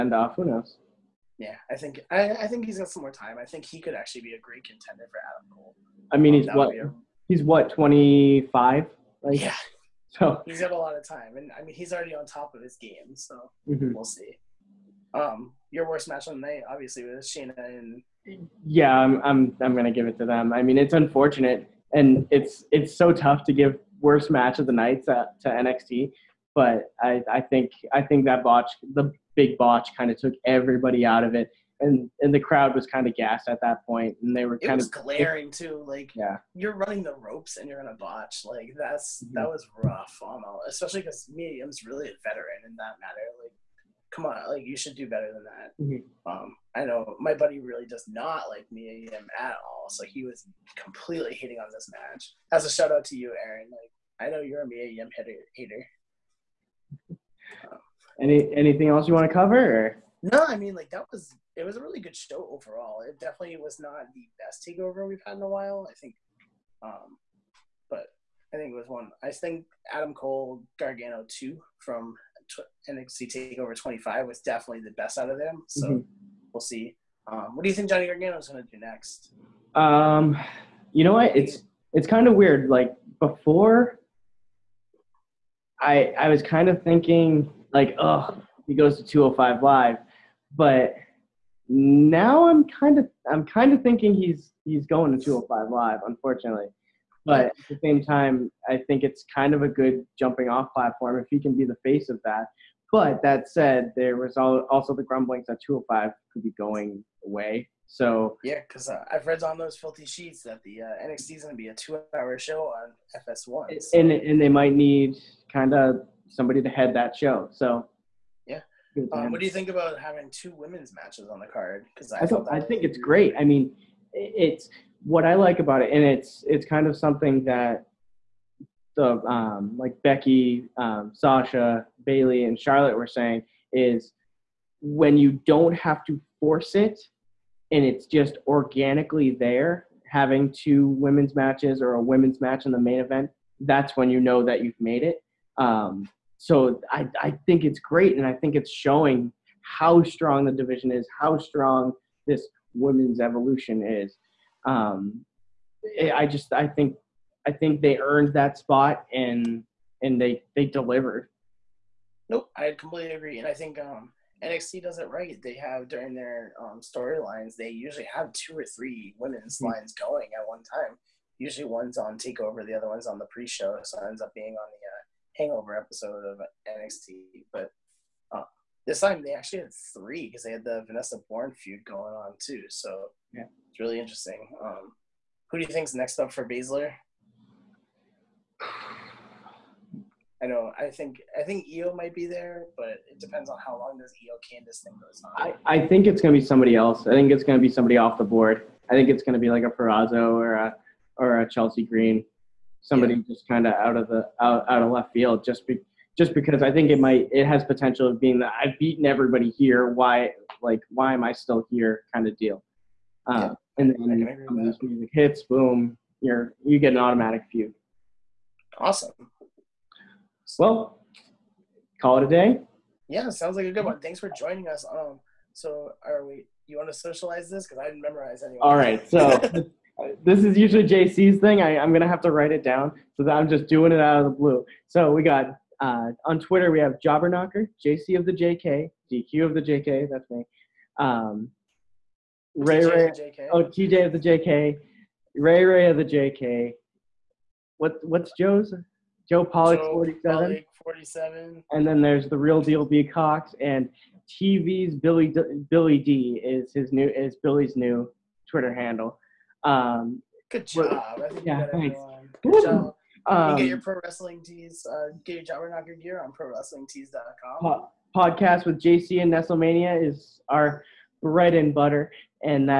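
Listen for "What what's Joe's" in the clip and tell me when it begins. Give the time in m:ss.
4:07.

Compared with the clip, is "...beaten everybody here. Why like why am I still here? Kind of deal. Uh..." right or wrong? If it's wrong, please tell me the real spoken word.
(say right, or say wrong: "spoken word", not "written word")
right.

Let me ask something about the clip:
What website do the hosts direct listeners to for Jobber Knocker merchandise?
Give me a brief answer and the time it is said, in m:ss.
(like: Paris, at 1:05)
prowrestlingtees.com, at 4:26.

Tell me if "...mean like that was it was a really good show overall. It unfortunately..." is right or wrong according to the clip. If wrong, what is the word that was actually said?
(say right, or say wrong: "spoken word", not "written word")
wrong: "definitely", not "unfortunately".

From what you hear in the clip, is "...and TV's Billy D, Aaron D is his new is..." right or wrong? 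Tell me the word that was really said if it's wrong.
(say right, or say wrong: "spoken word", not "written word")
wrong: "Billy", not "Aaron".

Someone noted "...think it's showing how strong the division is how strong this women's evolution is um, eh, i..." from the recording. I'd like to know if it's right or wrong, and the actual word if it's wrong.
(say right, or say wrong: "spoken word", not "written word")
right.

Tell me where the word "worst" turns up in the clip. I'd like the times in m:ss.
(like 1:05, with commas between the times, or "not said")
0:15, 0:24.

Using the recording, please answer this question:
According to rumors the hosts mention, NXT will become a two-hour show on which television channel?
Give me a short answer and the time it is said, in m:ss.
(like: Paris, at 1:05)
FS1, at 1:53.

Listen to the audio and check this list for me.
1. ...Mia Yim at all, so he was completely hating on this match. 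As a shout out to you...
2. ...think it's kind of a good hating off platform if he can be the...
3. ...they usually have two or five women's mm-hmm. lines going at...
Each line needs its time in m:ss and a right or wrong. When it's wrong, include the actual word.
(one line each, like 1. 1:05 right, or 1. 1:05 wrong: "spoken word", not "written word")
1. 0:48 right
2. 1:38 wrong: "jumping", not "hating"
3. 2:47 wrong: "three", not "five".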